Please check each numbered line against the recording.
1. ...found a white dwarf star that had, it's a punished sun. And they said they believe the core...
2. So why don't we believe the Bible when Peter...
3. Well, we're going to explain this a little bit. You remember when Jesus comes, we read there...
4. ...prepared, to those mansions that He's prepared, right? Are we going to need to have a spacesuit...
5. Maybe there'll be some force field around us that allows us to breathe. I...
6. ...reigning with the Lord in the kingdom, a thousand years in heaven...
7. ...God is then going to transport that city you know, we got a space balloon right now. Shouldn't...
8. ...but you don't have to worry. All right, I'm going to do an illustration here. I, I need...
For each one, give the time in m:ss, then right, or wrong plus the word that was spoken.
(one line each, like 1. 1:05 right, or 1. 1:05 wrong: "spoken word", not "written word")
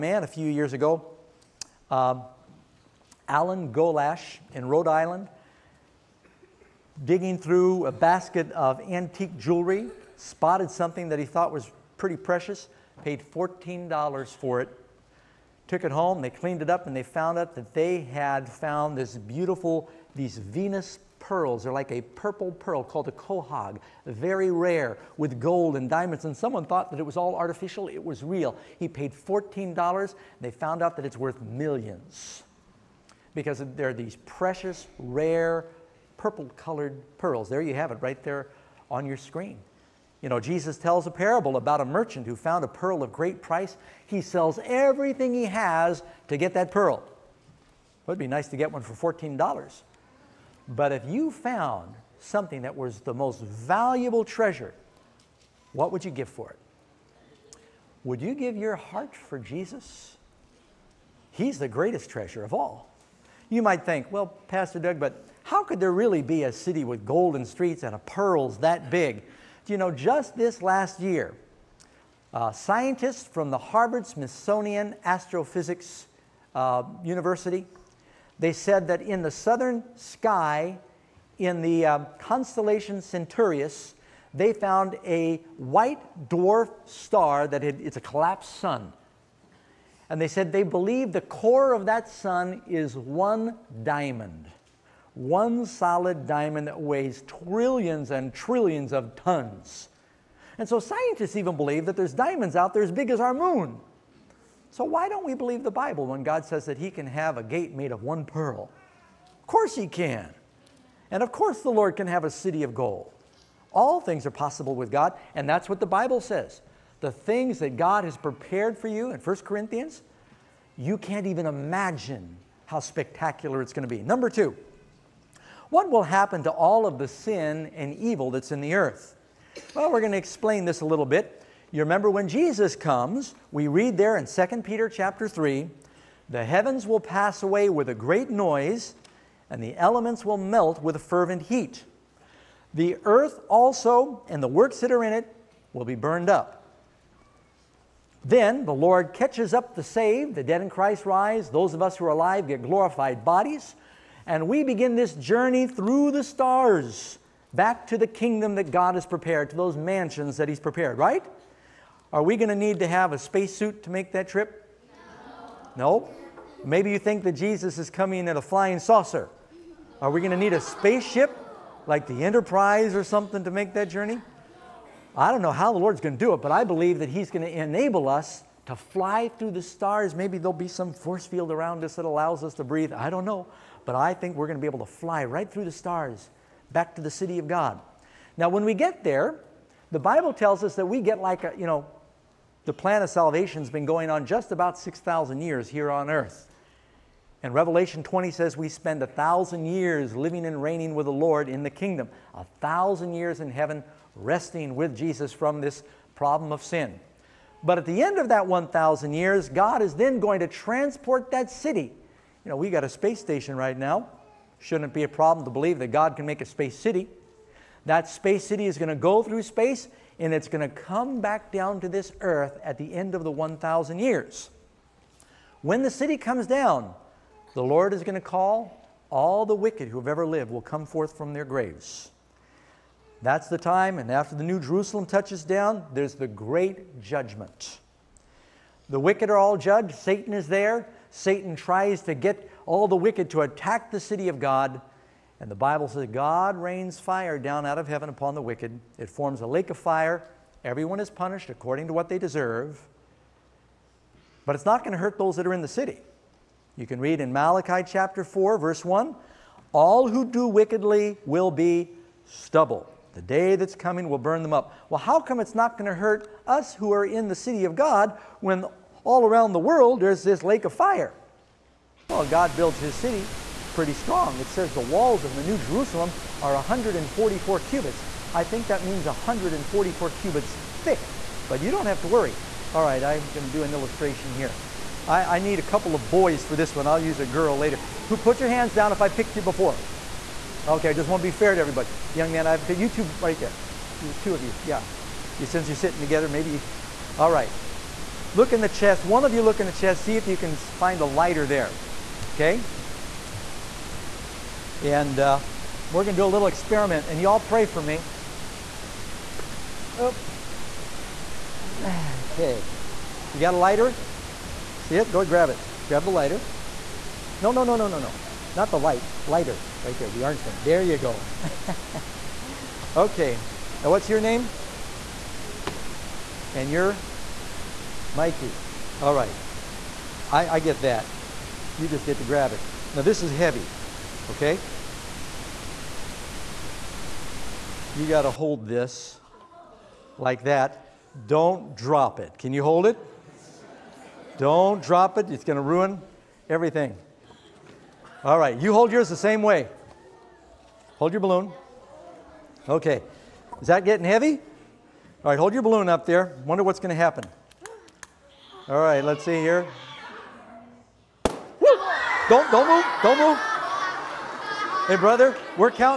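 1. 1:24 wrong: "collapsed", not "punished"
2. 1:44 wrong: "God", not "Peter"
3. 2:09 right
4. 2:39 right
5. 3:00 right
6. 3:20 right
7. 3:29 wrong: "station", not "balloon"
8. 4:41 right.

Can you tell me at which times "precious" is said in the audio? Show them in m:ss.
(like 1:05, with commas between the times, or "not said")
0:12, 0:34.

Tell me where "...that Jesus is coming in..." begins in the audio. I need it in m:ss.
2:47.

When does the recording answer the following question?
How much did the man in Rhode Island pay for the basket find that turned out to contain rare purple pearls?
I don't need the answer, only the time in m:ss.
0:13.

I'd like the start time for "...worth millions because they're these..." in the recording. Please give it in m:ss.
0:31.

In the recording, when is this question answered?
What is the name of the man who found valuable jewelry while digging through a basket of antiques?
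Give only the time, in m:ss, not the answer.
0:03.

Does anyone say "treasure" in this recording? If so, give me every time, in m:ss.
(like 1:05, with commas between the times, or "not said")
0:54, 1:02.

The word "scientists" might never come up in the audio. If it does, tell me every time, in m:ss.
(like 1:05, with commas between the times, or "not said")
1:12, 1:40.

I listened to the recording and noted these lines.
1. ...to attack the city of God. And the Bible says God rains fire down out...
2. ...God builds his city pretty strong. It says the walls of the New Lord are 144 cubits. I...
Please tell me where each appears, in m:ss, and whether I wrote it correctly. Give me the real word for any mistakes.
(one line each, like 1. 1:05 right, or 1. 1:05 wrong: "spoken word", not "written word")
1. 4:03 right
2. 4:32 wrong: "Jerusalem", not "Lord".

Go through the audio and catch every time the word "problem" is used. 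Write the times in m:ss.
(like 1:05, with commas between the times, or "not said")
3:26, 3:35.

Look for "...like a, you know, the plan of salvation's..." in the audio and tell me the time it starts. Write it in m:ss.
3:11.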